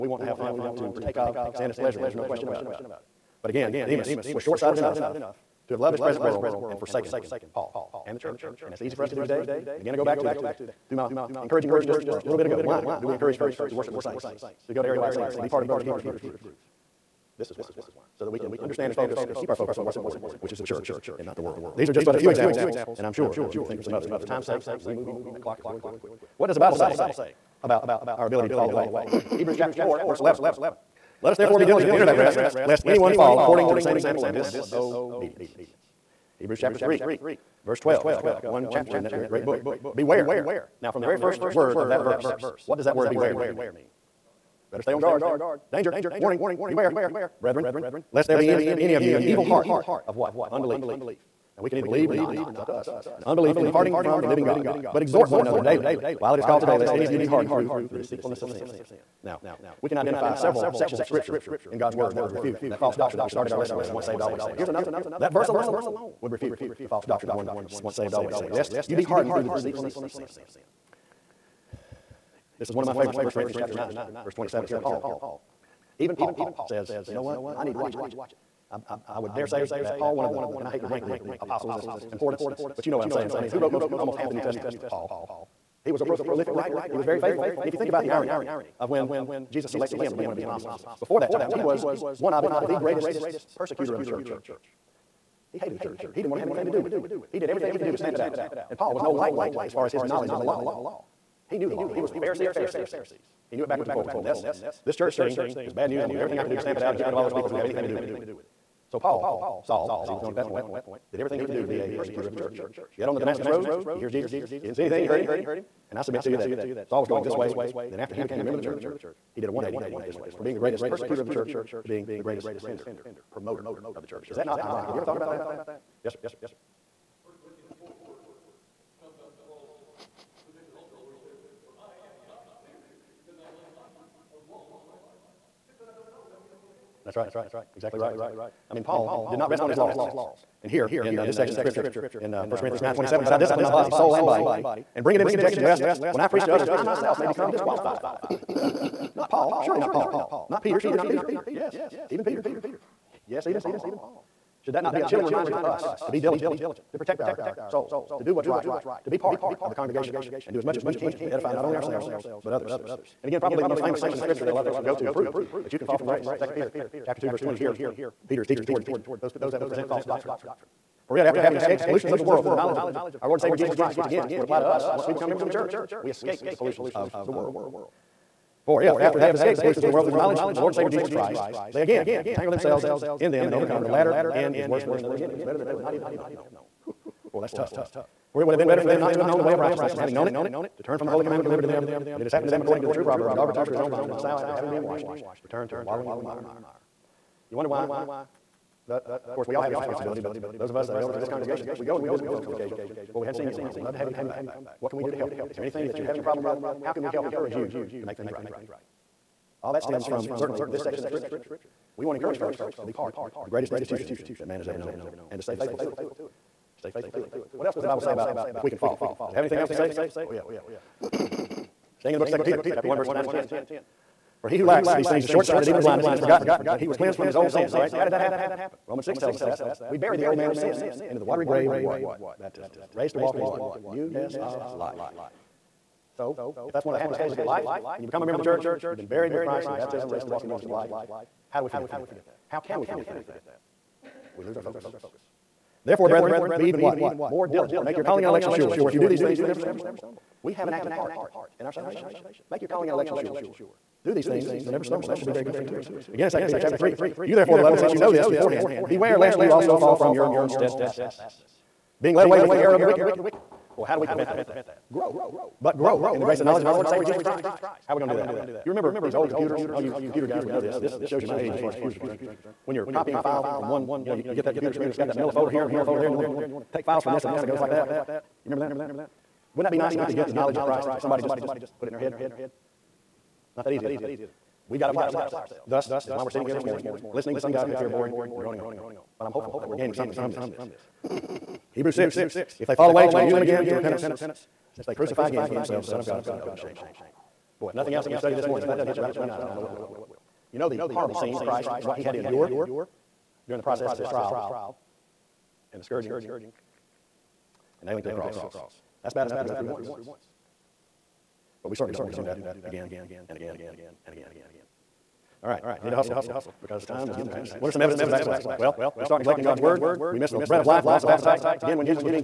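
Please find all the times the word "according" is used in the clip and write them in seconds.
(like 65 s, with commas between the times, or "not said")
33 s, 192 s.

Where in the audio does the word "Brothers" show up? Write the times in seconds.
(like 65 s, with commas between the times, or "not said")
15 s.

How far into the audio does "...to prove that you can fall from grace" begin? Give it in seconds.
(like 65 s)
165 s.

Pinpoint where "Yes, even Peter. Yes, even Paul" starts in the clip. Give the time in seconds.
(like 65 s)
151 s.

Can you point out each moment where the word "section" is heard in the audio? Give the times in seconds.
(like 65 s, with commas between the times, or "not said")
60 s, 141 s, 163 s, 210 s.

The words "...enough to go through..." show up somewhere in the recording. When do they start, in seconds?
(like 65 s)
309 s.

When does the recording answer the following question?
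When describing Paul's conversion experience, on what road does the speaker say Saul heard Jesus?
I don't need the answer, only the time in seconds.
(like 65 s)
113 s.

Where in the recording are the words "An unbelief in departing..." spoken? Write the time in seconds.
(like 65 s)
53 s.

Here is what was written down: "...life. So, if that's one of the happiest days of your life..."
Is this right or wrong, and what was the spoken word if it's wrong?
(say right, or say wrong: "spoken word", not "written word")
right.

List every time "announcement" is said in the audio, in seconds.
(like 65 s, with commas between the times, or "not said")
not said.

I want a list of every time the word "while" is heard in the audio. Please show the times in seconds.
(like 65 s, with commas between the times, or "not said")
56 s, 203 s.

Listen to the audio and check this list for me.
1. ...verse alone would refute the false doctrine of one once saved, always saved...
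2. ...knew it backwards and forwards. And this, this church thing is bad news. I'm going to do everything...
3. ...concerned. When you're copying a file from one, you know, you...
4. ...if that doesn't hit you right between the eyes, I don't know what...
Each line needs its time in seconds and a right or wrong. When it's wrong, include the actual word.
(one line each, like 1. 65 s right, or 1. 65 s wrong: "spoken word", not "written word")
1. 65 s right
2. 103 s right
3. 271 s right
4. 298 s right.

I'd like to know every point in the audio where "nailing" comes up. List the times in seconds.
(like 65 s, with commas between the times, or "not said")
307 s.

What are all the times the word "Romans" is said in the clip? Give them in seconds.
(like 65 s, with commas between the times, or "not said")
228 s.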